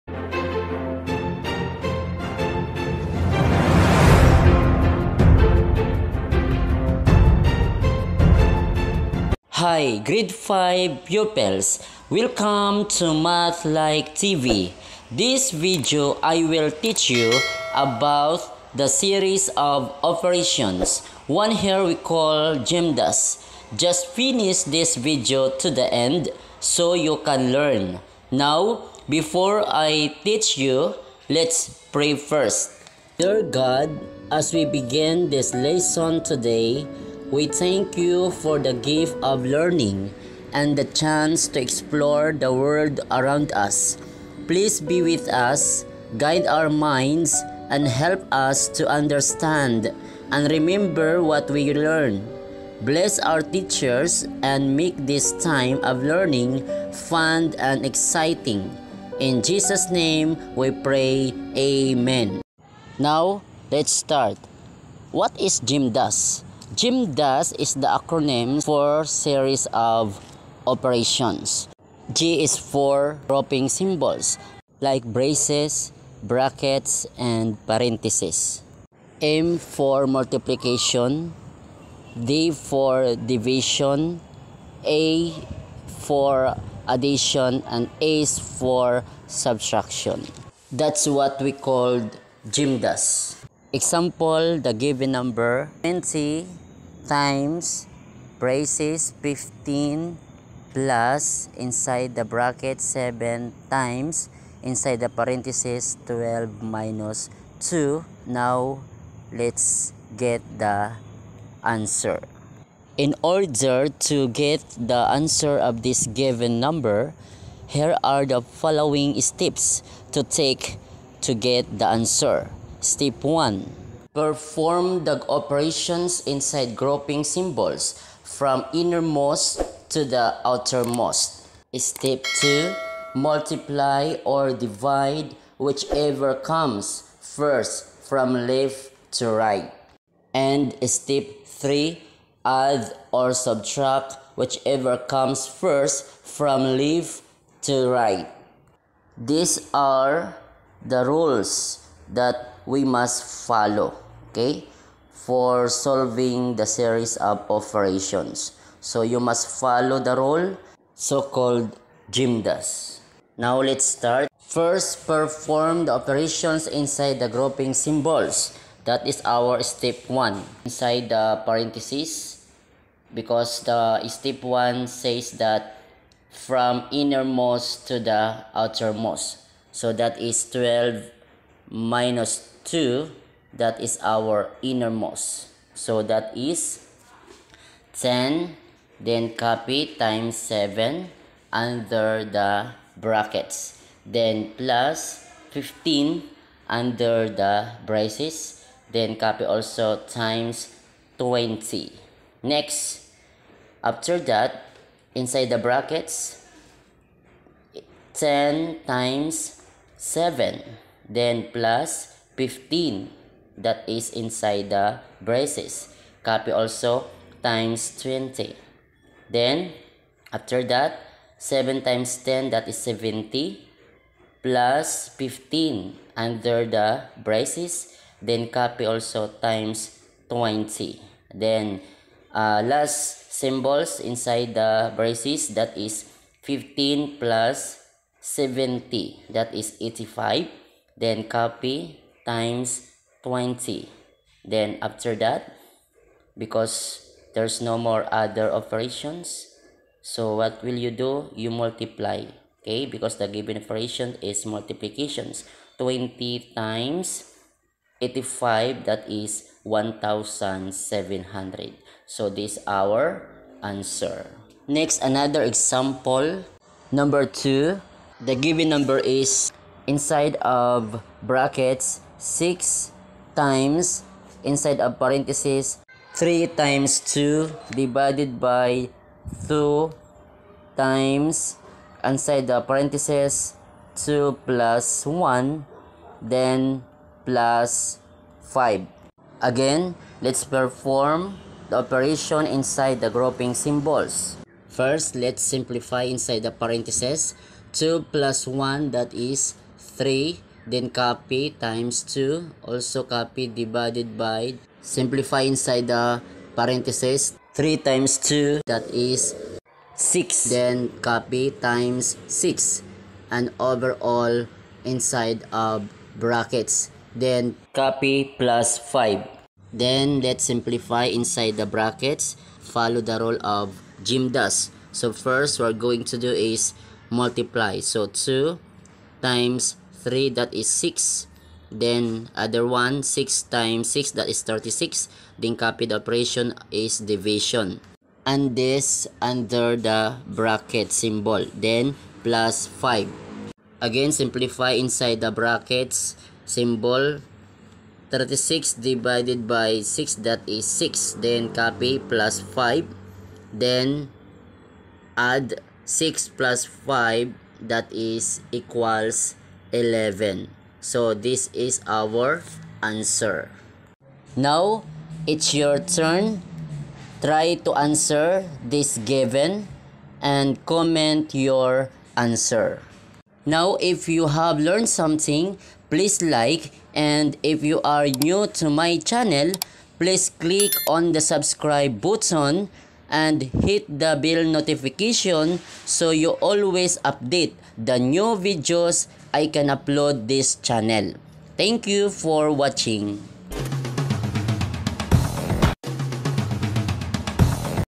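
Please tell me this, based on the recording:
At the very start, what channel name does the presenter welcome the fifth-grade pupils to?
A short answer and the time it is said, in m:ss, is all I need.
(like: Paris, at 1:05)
Math Like TV, at 0:13.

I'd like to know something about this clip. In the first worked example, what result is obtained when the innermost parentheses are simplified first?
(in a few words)
10.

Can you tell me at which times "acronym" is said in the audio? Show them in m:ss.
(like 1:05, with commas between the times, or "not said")
1:07.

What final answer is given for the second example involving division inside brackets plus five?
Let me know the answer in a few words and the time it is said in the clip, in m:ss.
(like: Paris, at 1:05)
11, at 5:59.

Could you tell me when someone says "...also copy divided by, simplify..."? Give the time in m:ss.
5:02.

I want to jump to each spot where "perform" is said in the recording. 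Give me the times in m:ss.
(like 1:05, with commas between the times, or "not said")
2:04, 2:45, 4:50.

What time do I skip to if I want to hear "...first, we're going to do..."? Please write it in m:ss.
5:25.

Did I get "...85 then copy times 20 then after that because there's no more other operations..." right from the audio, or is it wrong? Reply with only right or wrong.
right.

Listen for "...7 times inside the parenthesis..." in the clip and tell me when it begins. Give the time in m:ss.
1:42.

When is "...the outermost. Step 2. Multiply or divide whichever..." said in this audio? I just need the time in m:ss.
2:10.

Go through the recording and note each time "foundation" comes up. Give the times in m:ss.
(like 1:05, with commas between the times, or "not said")
not said.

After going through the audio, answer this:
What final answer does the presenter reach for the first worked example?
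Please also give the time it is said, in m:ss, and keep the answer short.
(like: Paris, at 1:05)
1700, at 4:19.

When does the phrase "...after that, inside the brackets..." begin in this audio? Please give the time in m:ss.
3:23.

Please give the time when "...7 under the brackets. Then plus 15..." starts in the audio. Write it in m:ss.
3:10.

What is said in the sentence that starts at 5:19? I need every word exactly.
Then, let's simplify inside the brackets.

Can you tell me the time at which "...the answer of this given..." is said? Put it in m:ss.
1:54.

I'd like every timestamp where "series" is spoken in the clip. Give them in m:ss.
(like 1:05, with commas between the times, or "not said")
0:18, 1:09, 2:36.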